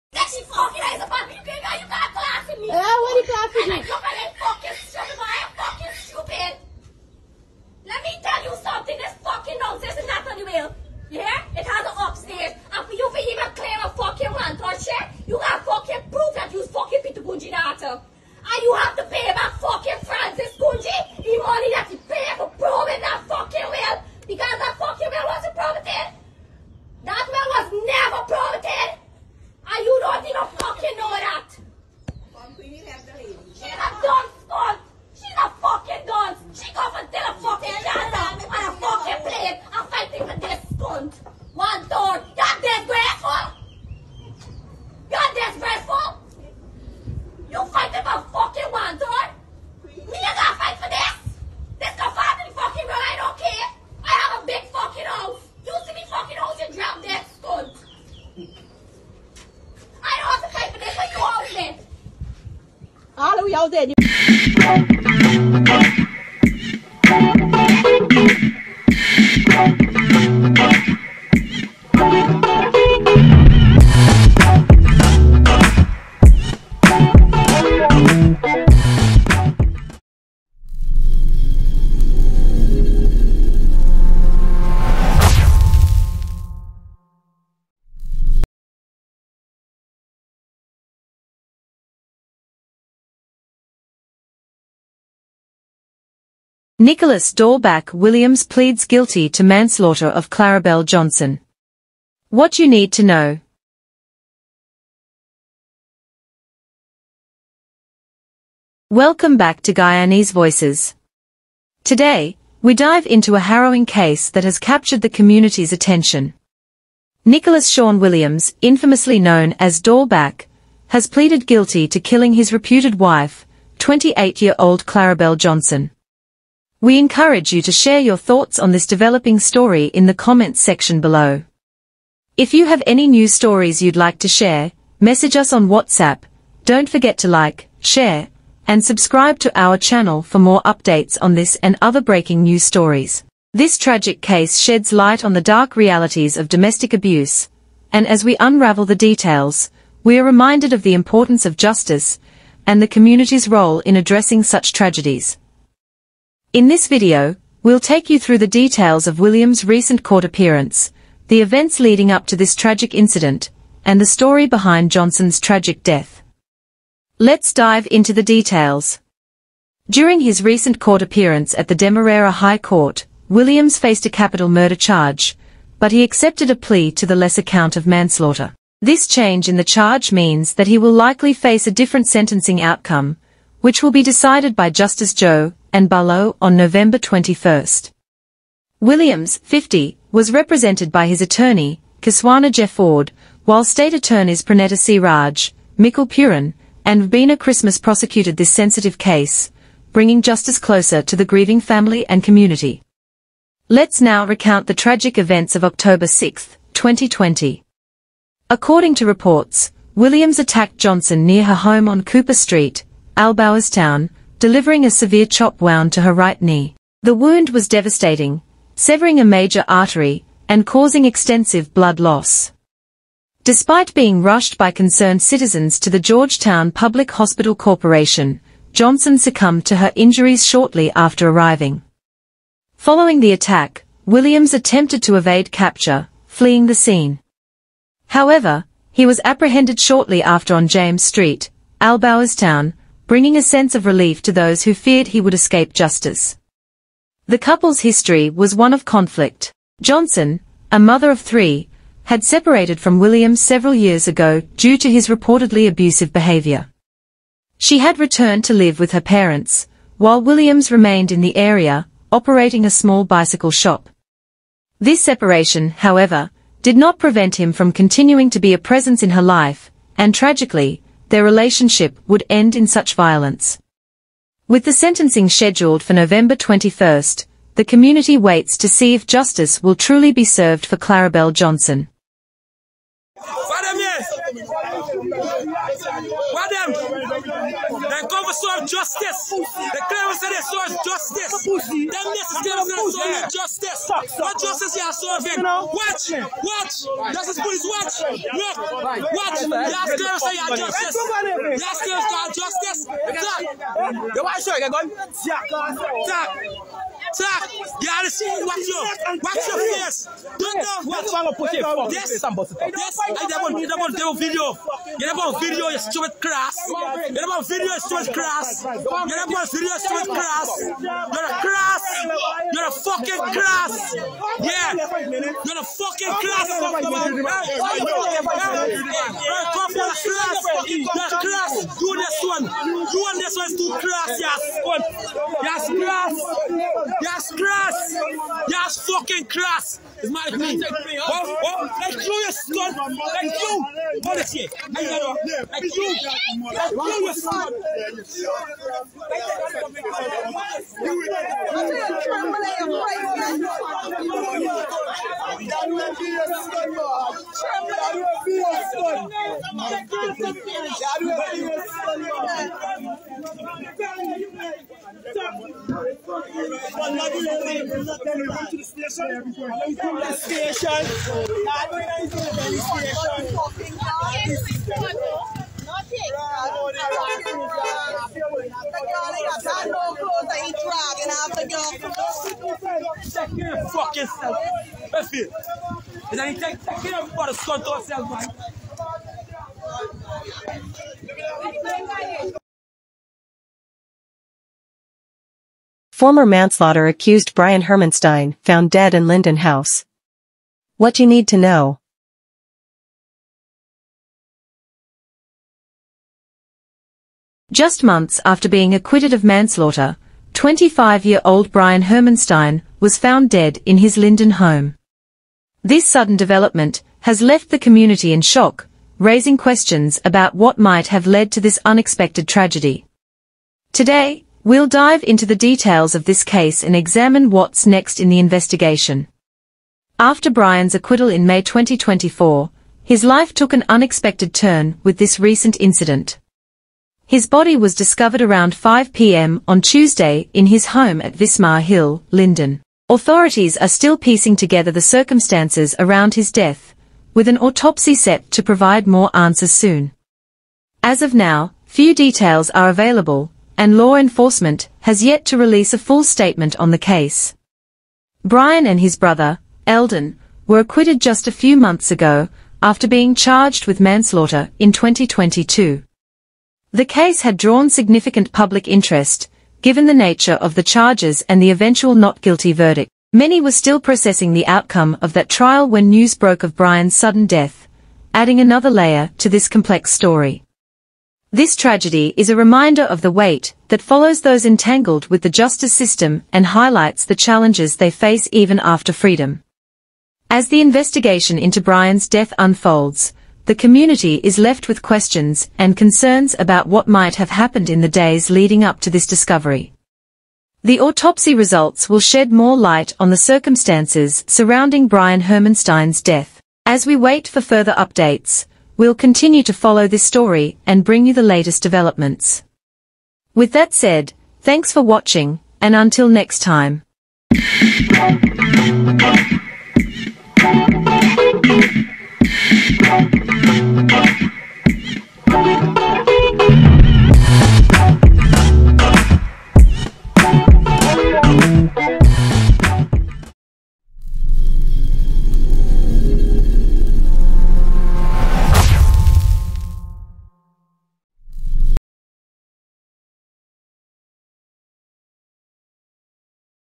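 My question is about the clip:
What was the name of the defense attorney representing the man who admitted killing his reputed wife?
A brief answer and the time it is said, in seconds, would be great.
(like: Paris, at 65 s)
Kiswana Jefford, at 192 s.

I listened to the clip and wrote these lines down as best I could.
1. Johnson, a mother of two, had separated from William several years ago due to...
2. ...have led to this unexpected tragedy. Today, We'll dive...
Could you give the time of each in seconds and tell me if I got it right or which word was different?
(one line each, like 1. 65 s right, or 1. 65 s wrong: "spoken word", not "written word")
1. 249 s wrong: "three", not "two"
2. 420 s right.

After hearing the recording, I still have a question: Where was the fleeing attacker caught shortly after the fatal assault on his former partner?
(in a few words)
James Street.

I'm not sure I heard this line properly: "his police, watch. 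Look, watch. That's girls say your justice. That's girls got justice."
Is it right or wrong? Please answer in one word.
right.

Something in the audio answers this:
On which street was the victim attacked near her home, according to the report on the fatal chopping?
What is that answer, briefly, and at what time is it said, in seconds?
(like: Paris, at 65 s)
Cooper Street, at 212 s.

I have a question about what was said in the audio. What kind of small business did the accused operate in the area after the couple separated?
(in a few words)
bicycle shop.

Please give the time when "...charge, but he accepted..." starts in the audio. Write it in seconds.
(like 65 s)
174 s.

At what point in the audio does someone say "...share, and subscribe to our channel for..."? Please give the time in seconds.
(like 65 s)
137 s.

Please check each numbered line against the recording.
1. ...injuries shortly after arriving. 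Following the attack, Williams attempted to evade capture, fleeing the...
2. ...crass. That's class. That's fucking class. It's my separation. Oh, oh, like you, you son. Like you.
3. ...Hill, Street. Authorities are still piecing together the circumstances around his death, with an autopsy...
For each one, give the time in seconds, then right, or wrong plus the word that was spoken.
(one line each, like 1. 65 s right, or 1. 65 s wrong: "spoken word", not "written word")
1. 229 s right
2. 335 s wrong: "opinion", not "separation"
3. 441 s wrong: "Linden", not "Street".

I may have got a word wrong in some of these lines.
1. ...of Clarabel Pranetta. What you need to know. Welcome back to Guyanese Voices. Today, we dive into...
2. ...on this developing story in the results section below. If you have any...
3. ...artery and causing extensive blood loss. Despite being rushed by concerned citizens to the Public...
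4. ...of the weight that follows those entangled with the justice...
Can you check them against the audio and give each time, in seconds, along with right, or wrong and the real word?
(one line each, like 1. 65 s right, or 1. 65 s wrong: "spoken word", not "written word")
1. 100 s wrong: "Johnson", not "Pranetta"
2. 128 s wrong: "comments", not "results"
3. 219 s wrong: "Georgetown", not "Public"
4. 482 s right.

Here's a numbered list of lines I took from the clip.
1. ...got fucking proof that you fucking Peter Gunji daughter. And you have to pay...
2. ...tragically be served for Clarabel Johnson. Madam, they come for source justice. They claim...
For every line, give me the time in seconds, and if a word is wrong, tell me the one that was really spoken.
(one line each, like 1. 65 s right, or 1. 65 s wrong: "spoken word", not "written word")
1. 15 s right
2. 279 s wrong: "truly", not "tragically".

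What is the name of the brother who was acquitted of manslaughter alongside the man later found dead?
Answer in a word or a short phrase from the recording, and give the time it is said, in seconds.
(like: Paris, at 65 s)
Eldon, at 459 s.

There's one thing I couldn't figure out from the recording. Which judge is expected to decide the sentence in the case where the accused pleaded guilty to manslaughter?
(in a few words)
Justice Joe, and Barlow.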